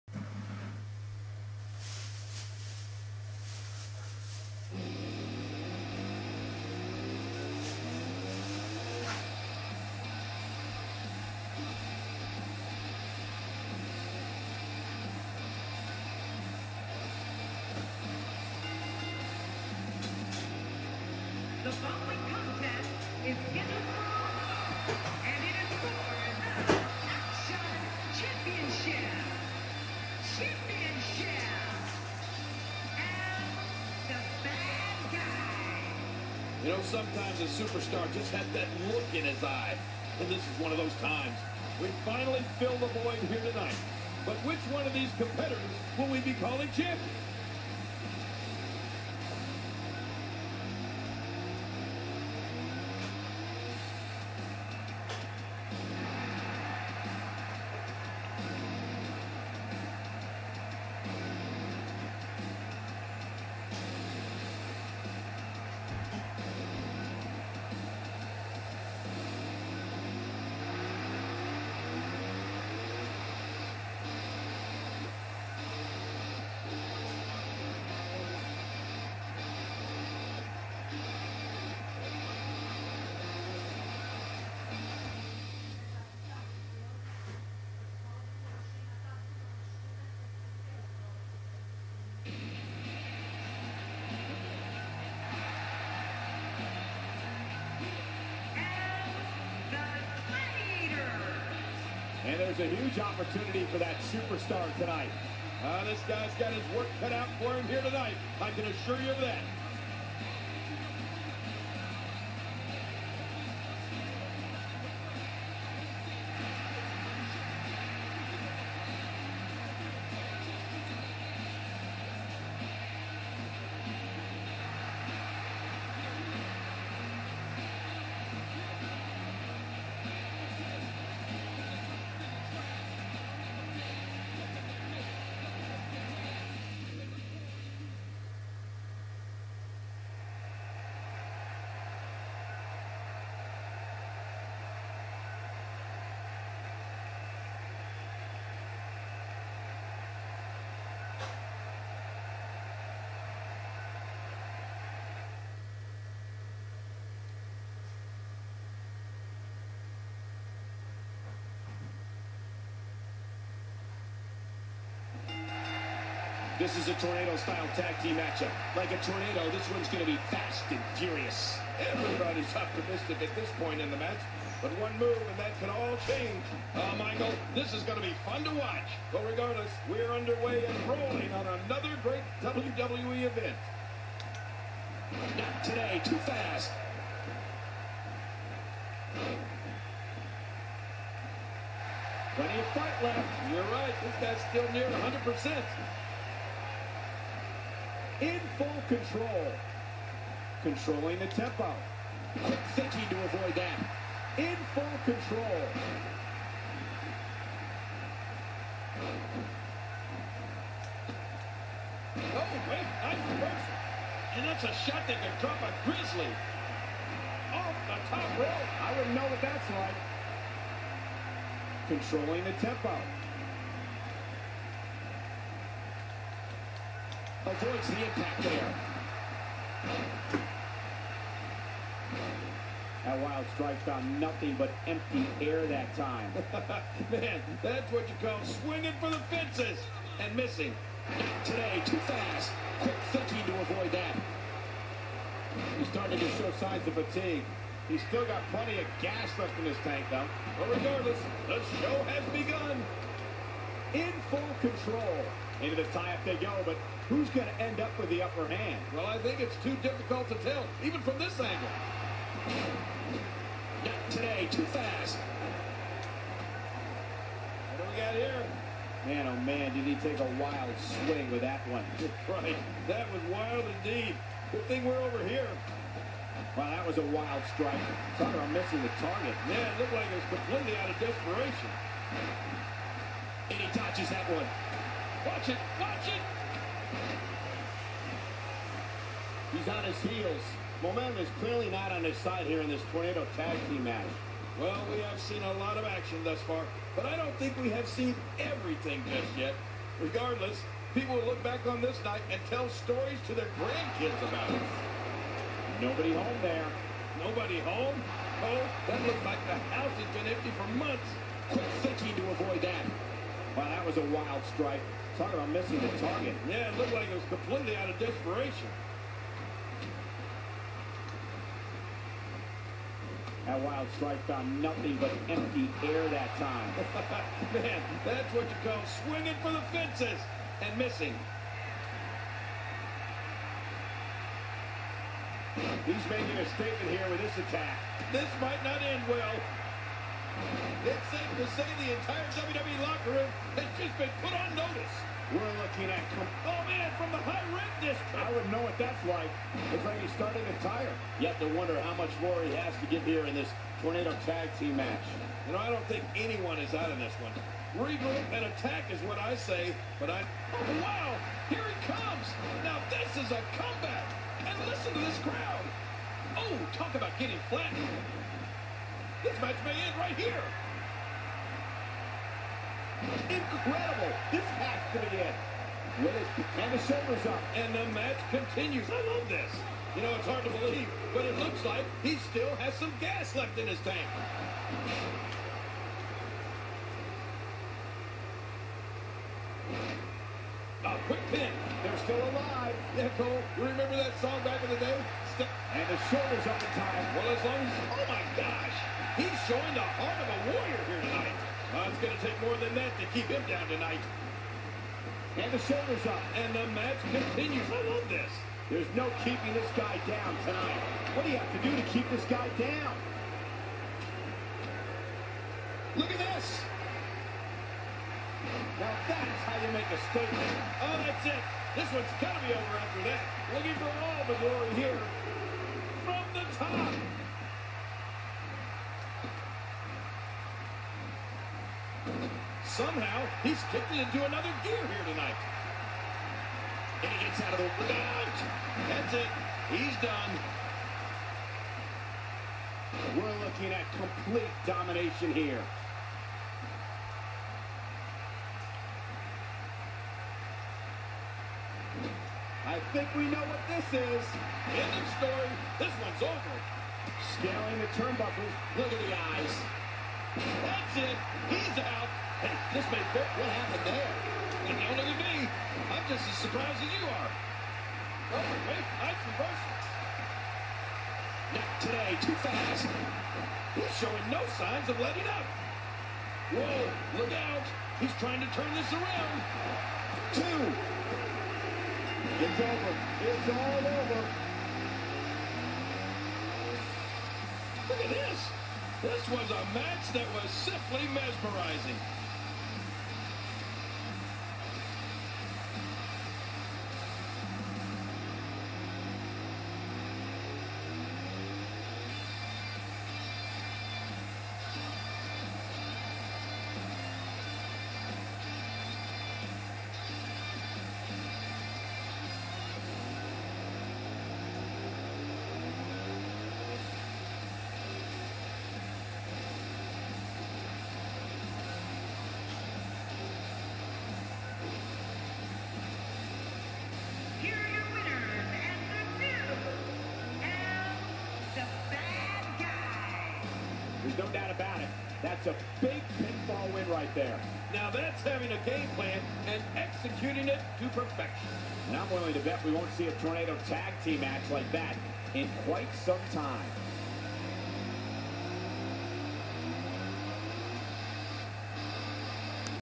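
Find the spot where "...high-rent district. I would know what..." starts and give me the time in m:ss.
5:47.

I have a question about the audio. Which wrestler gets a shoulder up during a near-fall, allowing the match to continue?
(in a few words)
Willis.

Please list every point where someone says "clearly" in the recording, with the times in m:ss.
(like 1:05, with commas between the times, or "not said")
4:51.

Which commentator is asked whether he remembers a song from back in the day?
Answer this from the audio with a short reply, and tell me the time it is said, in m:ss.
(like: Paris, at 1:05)
Cole, at 6:33.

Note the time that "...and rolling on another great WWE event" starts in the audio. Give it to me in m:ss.
3:00.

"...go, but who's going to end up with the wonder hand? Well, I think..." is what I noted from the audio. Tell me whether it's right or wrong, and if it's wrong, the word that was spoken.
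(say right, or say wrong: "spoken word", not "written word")
wrong: "upper", not "wonder".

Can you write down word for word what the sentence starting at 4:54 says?
Well, we have seen a lot of action thus far, but I don't think we have seen everything just yet.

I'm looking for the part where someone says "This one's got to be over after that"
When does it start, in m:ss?
7:01.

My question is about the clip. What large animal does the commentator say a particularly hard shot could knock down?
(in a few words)
A grizzly.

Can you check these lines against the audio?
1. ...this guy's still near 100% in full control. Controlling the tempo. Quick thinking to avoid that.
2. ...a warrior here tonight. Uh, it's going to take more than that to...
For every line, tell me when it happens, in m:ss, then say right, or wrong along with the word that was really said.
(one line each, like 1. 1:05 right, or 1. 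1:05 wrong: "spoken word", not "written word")
1. 3:14 right
2. 6:40 right.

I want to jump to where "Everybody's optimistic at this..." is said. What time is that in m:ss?
2:51.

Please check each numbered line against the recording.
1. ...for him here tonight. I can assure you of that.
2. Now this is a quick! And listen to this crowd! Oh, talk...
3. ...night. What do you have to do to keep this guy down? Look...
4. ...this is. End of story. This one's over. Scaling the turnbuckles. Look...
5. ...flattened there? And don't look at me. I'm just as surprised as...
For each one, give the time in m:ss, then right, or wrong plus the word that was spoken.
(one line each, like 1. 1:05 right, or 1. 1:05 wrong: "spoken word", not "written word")
1. 1:47 right
2. 6:02 wrong: "comeback", not "quick"
3. 6:50 wrong: "tonight", not "night"
4. 7:33 right
5. 7:43 wrong: "happened", not "flattened".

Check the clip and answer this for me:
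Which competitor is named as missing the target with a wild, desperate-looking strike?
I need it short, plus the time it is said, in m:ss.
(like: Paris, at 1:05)
Tucker, at 4:38.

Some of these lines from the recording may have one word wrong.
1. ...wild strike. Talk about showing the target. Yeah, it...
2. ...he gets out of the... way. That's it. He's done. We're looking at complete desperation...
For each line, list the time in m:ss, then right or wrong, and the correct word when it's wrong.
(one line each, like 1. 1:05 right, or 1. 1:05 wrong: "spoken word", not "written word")
1. 5:14 wrong: "missing", not "showing"
2. 7:17 wrong: "domination", not "desperation".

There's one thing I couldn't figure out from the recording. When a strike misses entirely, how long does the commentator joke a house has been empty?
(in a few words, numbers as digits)
Months.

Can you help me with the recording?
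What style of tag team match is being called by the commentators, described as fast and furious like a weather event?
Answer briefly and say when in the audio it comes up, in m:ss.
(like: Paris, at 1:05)
Tornado-style, at 2:47.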